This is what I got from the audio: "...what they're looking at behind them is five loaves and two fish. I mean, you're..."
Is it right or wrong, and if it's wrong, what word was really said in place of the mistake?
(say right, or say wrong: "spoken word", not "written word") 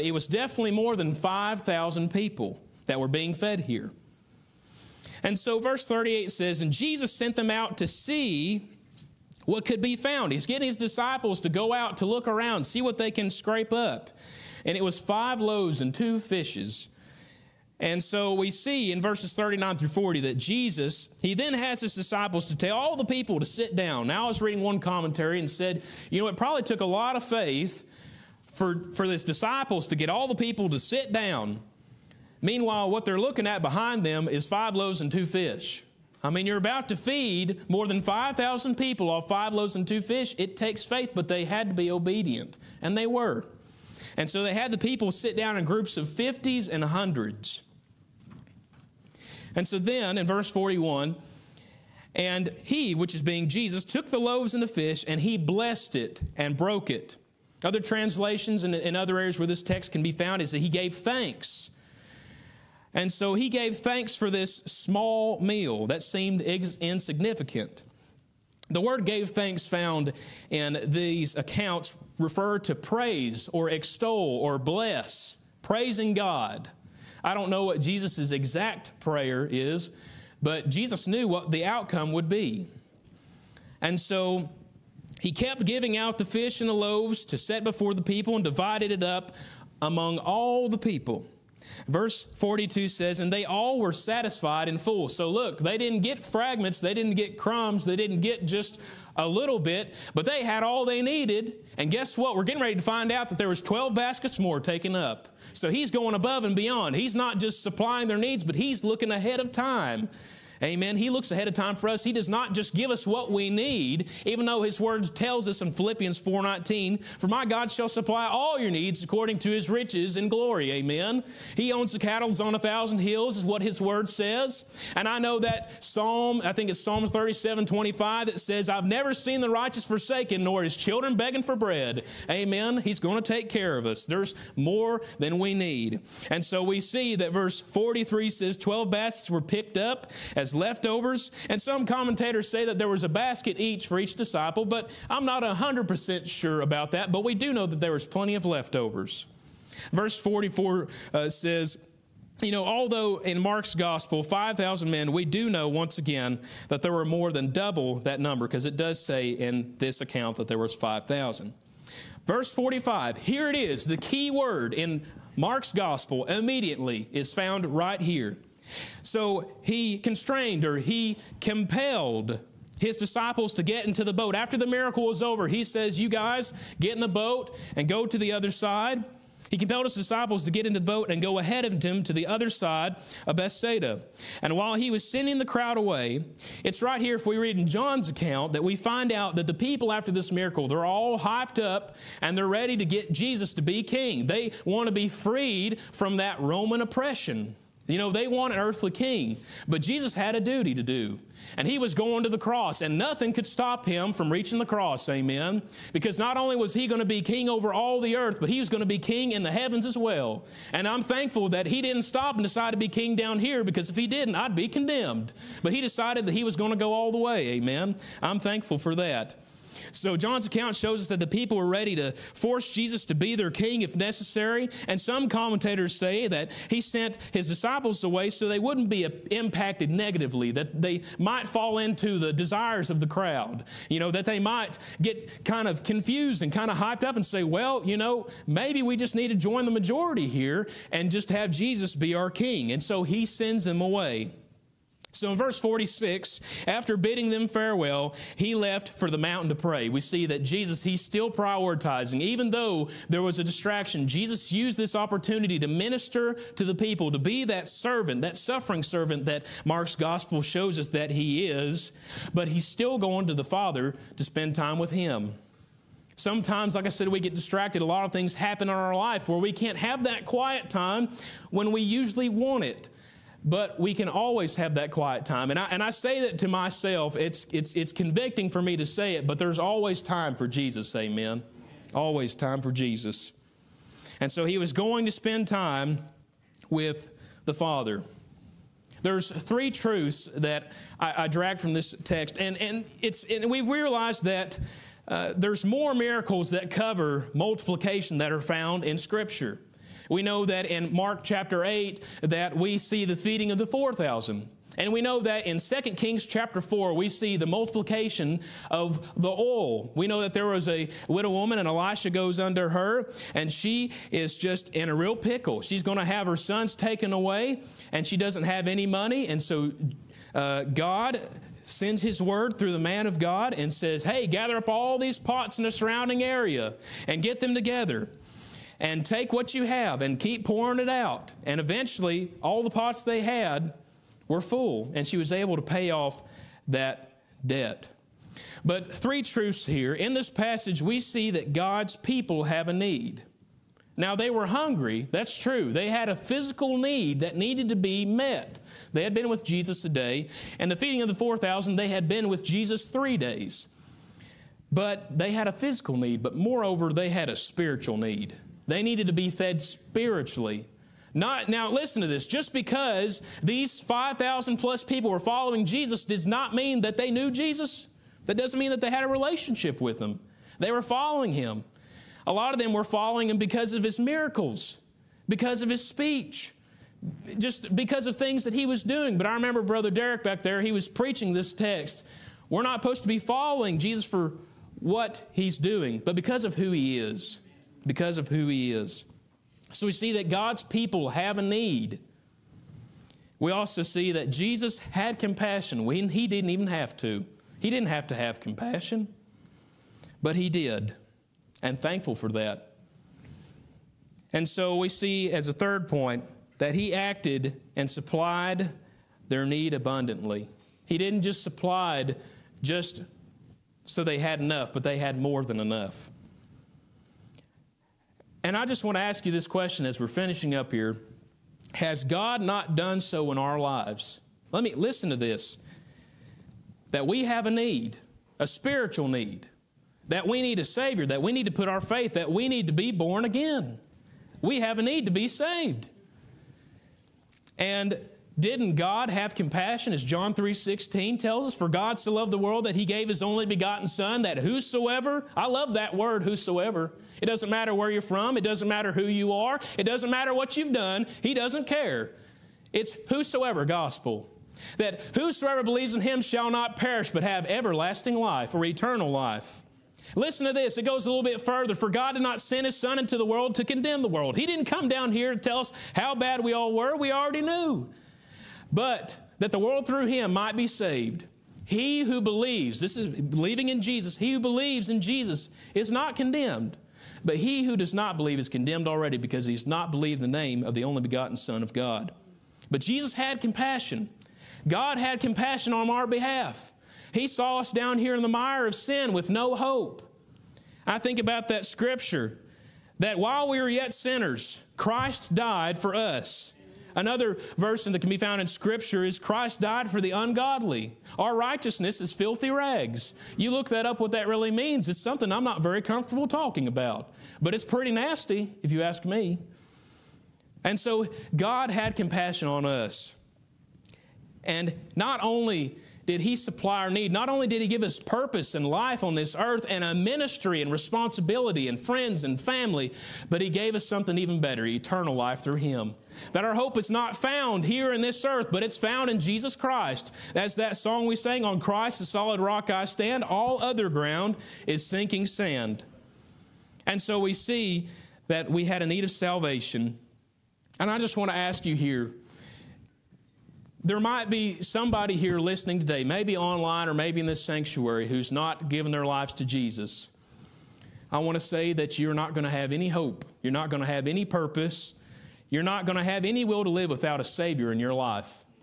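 right.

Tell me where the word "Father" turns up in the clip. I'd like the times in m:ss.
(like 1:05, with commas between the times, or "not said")
4:23, 4:47.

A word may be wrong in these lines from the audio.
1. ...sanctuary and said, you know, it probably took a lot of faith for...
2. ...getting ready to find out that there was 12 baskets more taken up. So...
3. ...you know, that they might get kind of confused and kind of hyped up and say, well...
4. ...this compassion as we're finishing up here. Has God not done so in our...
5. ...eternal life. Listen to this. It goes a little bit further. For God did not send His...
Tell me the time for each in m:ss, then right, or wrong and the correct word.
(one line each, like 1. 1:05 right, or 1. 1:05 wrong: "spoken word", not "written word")
1. 0:24 wrong: "commentary", not "sanctuary"
2. 1:42 right
3. 3:53 right
4. 6:59 wrong: "question", not "compassion"
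5. 7:38 right.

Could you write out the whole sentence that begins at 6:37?
He didn't have to have compassion, but He did, and thankful for that.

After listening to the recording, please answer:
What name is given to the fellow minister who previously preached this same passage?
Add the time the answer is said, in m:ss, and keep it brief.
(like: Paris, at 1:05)
Brother Derek, at 6:19.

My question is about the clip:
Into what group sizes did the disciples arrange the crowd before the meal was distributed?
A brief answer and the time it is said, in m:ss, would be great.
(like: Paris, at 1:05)
50s and 100s, at 0:46.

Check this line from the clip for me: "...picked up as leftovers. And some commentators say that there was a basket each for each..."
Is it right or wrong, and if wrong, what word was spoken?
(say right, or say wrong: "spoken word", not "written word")
right.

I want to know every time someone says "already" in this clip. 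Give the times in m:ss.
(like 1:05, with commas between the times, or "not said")
7:47, 7:58.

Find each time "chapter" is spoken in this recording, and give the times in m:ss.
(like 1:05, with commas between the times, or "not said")
5:01, 5:06.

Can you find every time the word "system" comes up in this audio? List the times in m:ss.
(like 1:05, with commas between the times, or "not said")
not said.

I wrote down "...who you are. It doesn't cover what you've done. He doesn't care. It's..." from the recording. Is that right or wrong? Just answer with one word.
wrong.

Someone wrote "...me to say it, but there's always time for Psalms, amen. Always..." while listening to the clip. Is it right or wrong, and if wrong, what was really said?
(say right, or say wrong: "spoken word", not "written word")
wrong: "Jesus", not "Psalms".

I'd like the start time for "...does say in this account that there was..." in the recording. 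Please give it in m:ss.
2:38.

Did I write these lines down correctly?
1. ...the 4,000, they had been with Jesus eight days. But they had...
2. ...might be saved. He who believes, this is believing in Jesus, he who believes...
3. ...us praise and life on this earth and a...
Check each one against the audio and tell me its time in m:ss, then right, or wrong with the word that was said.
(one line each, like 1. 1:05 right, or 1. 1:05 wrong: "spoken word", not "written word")
1. 5:51 wrong: "three", not "eight"
2. 7:50 right
3. 8:37 wrong: "purpose", not "praise".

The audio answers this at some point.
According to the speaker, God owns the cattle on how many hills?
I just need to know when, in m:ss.
2:02.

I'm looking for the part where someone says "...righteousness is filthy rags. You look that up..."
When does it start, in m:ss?
8:21.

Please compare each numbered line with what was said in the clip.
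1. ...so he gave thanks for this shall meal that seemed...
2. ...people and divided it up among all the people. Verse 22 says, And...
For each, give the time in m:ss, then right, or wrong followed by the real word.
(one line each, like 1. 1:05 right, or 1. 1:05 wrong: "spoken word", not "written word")
1. 1:03 wrong: "small", not "shall"
2. 1:28 wrong: "42", not "22".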